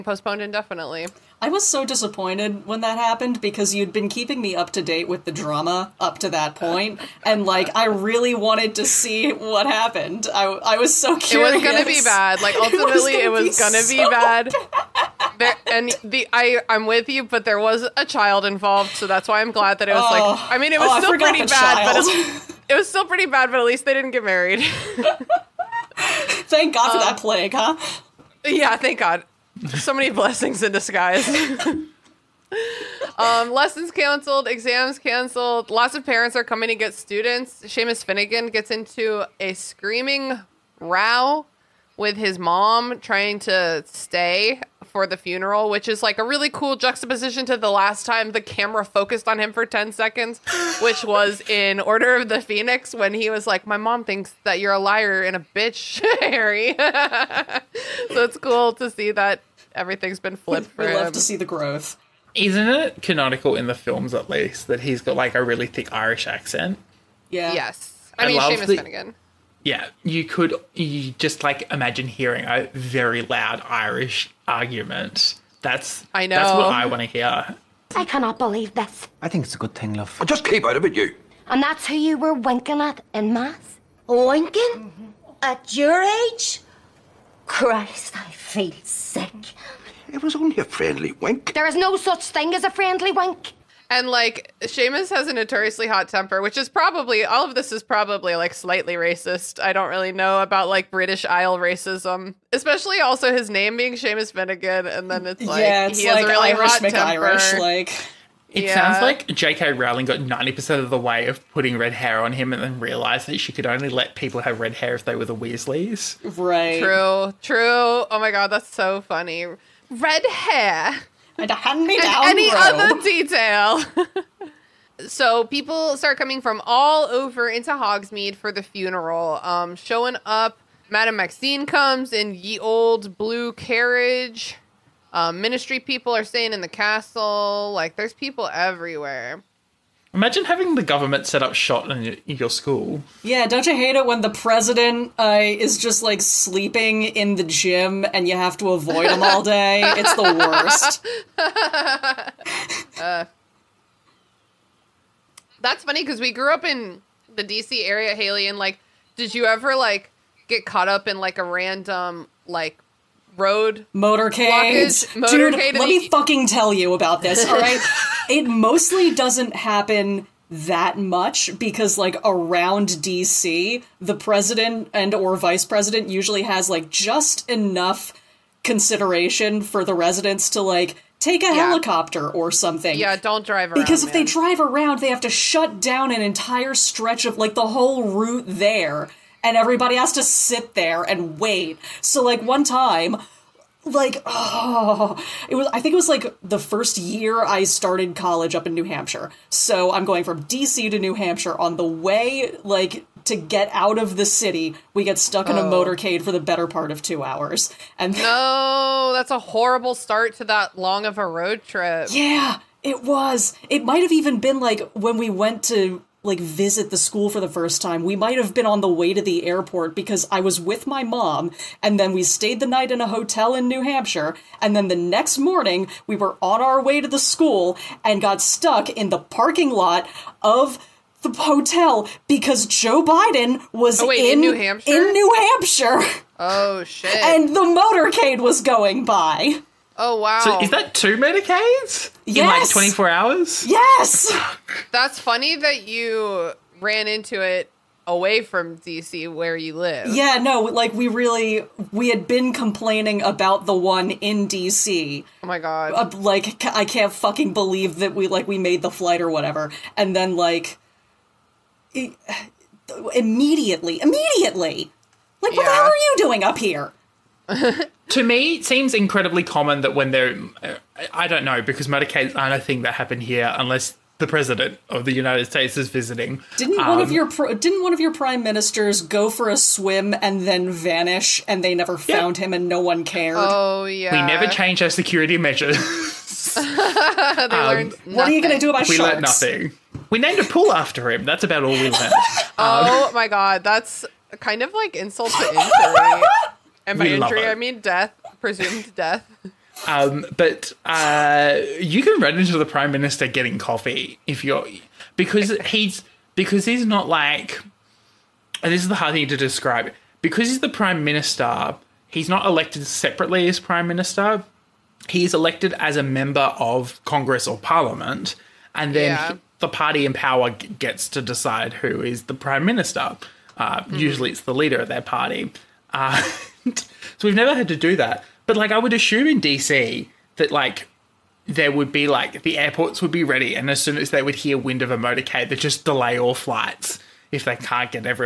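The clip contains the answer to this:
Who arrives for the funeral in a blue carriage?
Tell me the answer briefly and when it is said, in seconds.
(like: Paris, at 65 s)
Madame Maxime, at 130 s.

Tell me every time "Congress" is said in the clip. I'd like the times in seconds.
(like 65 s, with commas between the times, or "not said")
317 s.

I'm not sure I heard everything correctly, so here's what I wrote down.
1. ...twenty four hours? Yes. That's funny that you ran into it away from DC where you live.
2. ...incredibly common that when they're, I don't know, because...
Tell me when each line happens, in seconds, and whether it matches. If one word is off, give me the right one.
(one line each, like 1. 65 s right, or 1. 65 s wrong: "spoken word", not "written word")
1. 242 s right
2. 268 s right.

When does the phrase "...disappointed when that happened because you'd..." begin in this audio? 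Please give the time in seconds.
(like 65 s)
1 s.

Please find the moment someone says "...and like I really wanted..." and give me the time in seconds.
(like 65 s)
7 s.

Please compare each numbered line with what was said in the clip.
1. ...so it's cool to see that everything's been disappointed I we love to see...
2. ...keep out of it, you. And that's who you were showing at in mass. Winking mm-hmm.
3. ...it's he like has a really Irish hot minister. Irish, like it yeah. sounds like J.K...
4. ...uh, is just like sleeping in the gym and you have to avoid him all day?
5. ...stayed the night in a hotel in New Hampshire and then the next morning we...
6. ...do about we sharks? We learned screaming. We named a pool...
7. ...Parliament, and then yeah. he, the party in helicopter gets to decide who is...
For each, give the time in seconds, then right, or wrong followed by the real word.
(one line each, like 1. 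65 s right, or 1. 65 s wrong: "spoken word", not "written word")
1. 56 s wrong: "flipped", not "disappointed"
2. 80 s wrong: "winking", not "showing"
3. 105 s wrong: "temper", not "minister"
4. 145 s right
5. 222 s right
6. 288 s wrong: "nothing", not "screaming"
7. 317 s wrong: "power", not "helicopter".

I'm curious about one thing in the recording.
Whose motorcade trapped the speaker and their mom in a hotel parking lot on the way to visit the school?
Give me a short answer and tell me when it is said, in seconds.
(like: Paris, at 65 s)
Joe Biden, at 232 s.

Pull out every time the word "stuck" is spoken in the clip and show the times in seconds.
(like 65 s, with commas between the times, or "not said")
205 s, 228 s.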